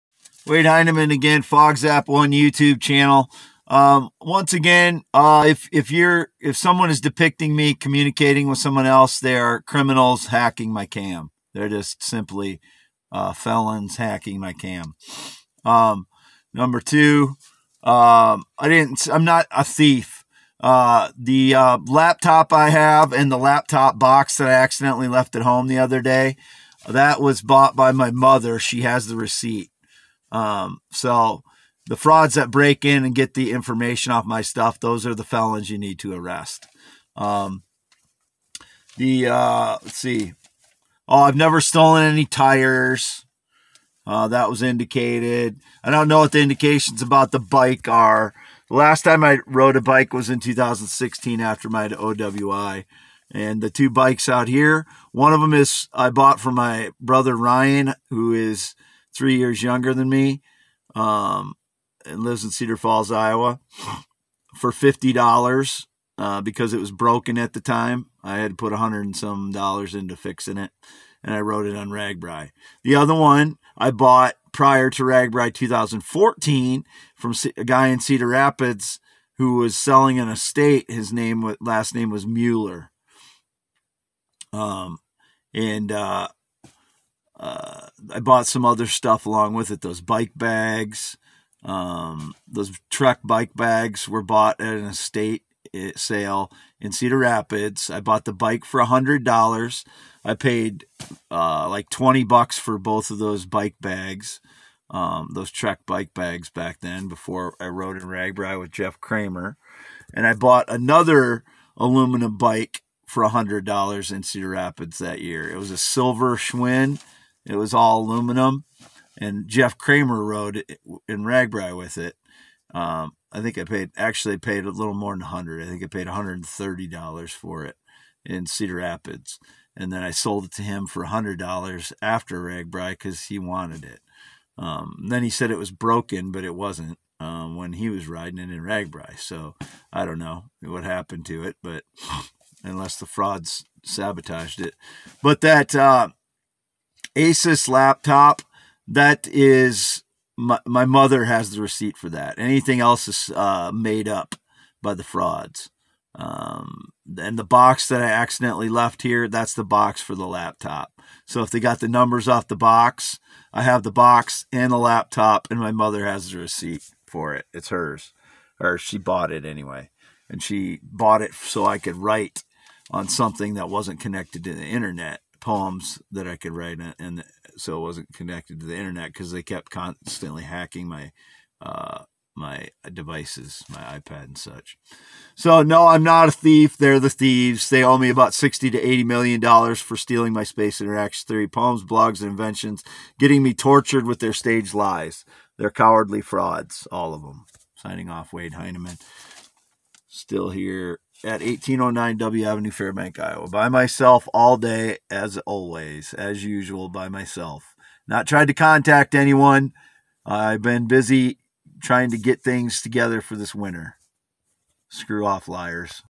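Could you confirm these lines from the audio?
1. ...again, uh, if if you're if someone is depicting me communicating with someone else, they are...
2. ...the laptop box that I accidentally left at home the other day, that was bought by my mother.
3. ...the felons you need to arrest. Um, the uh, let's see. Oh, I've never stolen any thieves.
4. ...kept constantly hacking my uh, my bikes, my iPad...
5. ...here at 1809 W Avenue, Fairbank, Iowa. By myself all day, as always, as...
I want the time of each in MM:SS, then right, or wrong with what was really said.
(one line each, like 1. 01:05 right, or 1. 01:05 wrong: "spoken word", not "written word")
1. 00:04 right
2. 00:23 right
3. 00:35 wrong: "tires", not "thieves"
4. 02:59 wrong: "devices", not "bikes"
5. 03:20 right.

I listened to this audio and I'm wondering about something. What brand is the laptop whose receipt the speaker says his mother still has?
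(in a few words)
Asus.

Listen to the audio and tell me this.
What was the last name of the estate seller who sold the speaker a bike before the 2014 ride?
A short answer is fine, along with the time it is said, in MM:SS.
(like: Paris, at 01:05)
Mueller, at 01:22.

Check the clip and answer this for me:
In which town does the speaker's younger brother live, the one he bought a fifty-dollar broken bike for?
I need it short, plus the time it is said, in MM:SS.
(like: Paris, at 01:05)
Cedar Falls, at 01:02.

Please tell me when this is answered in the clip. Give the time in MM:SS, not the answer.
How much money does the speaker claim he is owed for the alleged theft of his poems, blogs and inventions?
03:08.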